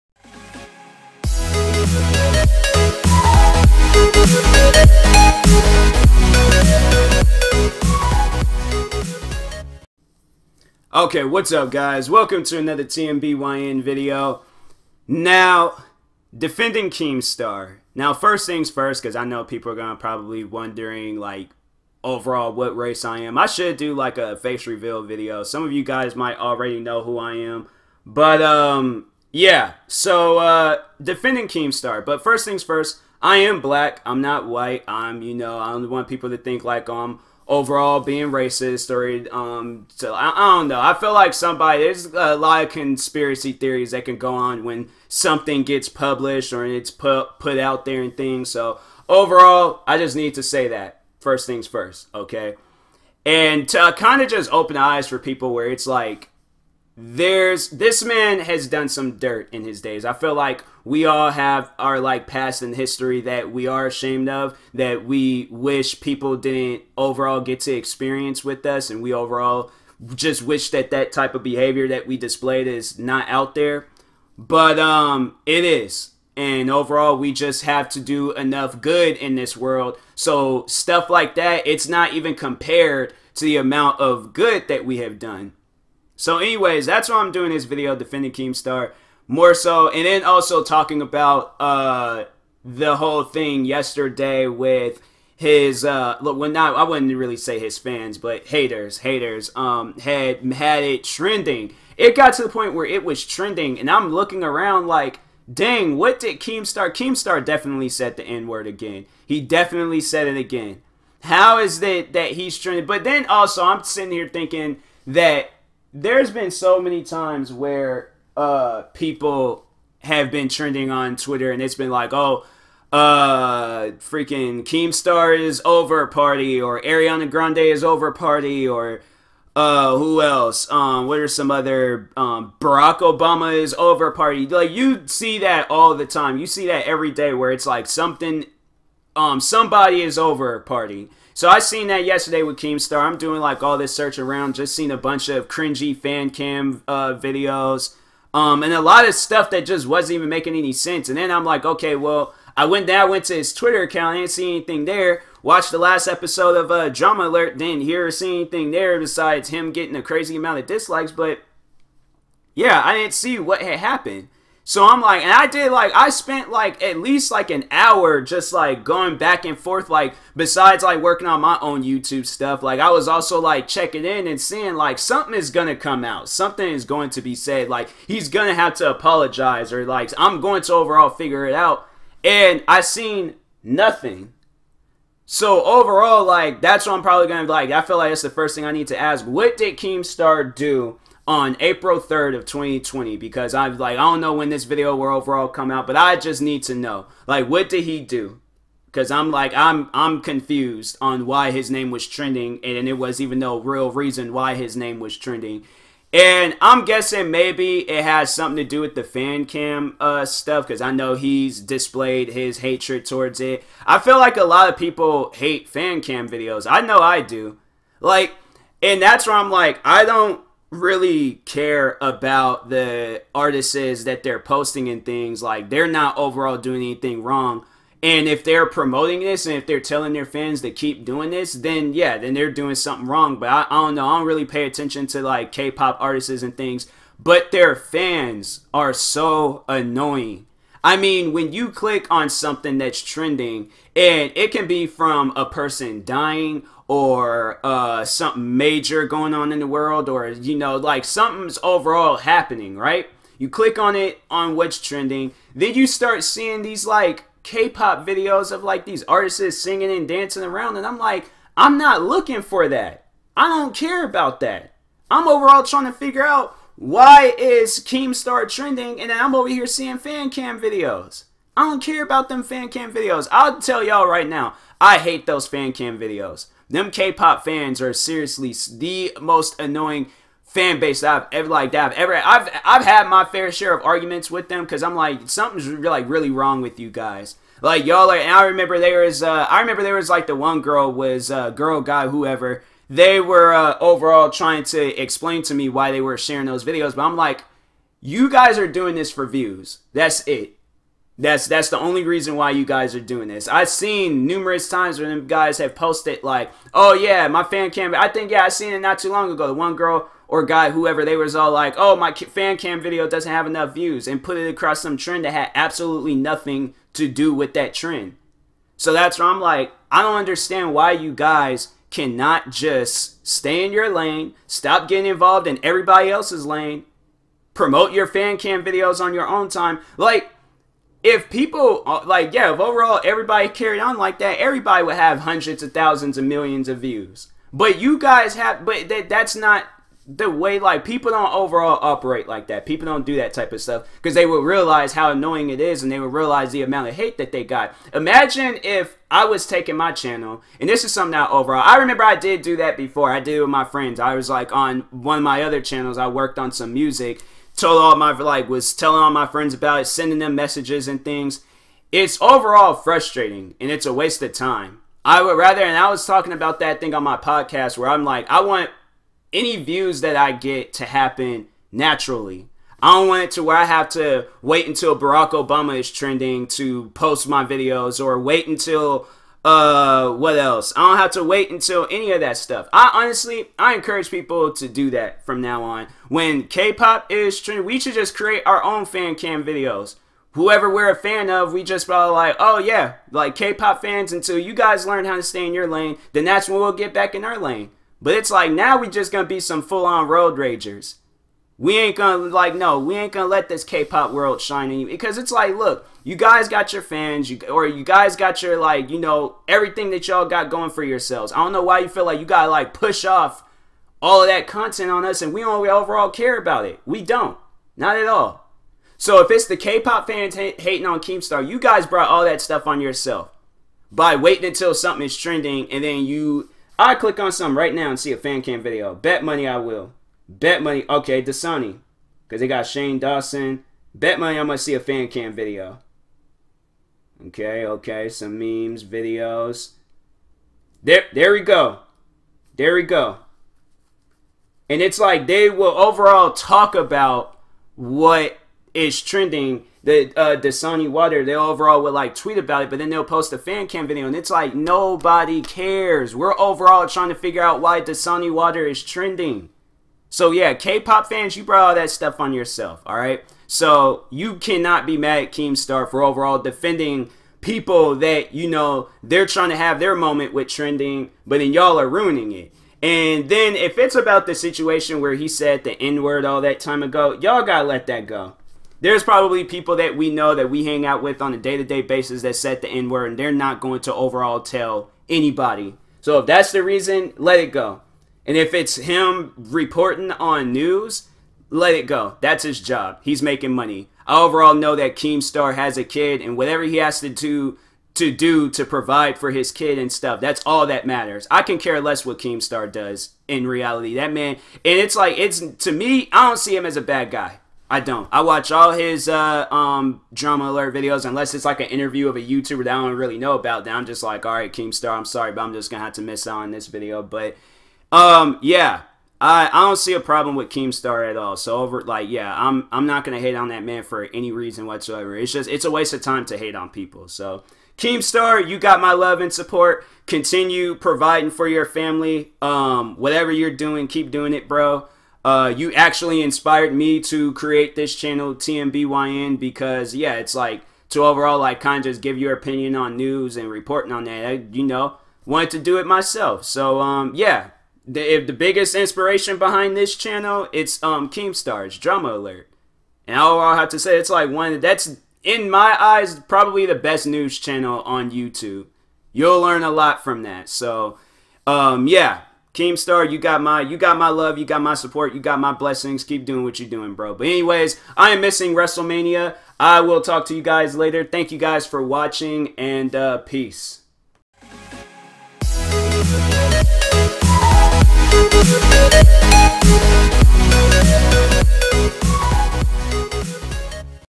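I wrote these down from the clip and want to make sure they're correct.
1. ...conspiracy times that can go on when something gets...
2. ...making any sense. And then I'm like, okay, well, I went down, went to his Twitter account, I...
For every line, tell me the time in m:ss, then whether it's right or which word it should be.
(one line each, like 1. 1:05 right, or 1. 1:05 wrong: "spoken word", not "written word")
1. 0:42 wrong: "theories", not "times"
2. 2:30 right.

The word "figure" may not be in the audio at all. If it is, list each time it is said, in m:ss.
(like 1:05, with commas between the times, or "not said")
3:01, 4:25, 7:37.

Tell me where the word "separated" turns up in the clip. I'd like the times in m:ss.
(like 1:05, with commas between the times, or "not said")
not said.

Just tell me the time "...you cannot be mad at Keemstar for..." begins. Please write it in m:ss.
7:44.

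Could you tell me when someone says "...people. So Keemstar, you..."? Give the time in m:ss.
8:46.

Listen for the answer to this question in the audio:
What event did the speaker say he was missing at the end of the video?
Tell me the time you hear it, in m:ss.
9:28.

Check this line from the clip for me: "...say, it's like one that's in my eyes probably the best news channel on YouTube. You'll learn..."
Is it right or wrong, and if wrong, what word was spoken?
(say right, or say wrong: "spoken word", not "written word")
right.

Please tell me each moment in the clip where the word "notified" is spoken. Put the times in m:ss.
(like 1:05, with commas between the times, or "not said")
not said.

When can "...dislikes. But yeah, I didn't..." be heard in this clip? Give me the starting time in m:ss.
2:40.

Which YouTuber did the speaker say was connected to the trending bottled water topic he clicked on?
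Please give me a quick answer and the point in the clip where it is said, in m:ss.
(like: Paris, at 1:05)
Shane Dawson, at 7:12.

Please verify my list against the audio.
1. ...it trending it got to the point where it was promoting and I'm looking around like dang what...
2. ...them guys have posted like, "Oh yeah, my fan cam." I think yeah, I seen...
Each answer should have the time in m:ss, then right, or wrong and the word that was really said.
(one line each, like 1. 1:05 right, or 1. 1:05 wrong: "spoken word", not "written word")
1. 1:40 wrong: "trending", not "promoting"
2. 5:05 right.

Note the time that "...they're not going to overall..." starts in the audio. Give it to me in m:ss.
8:03.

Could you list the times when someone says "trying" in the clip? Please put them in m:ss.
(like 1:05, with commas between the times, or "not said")
4:25, 4:54, 7:36, 7:49.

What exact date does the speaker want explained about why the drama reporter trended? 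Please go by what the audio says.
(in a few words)
April 3rd, 2020.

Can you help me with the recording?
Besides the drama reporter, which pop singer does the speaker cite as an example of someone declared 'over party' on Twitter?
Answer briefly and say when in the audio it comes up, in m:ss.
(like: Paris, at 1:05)
Ariana Grande, at 2:06.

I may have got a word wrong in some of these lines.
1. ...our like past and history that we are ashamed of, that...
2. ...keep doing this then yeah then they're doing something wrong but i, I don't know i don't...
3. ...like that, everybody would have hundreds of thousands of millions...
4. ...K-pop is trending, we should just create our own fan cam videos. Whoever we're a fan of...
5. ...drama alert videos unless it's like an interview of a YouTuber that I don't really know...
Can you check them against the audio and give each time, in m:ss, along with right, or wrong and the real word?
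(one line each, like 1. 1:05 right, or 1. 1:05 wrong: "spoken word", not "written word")
1. 1:01 right
2. 3:50 right
3. 5:33 right
4. 6:26 right
5. 8:30 right.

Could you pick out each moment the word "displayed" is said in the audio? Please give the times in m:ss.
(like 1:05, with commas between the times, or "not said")
1:12, 3:31.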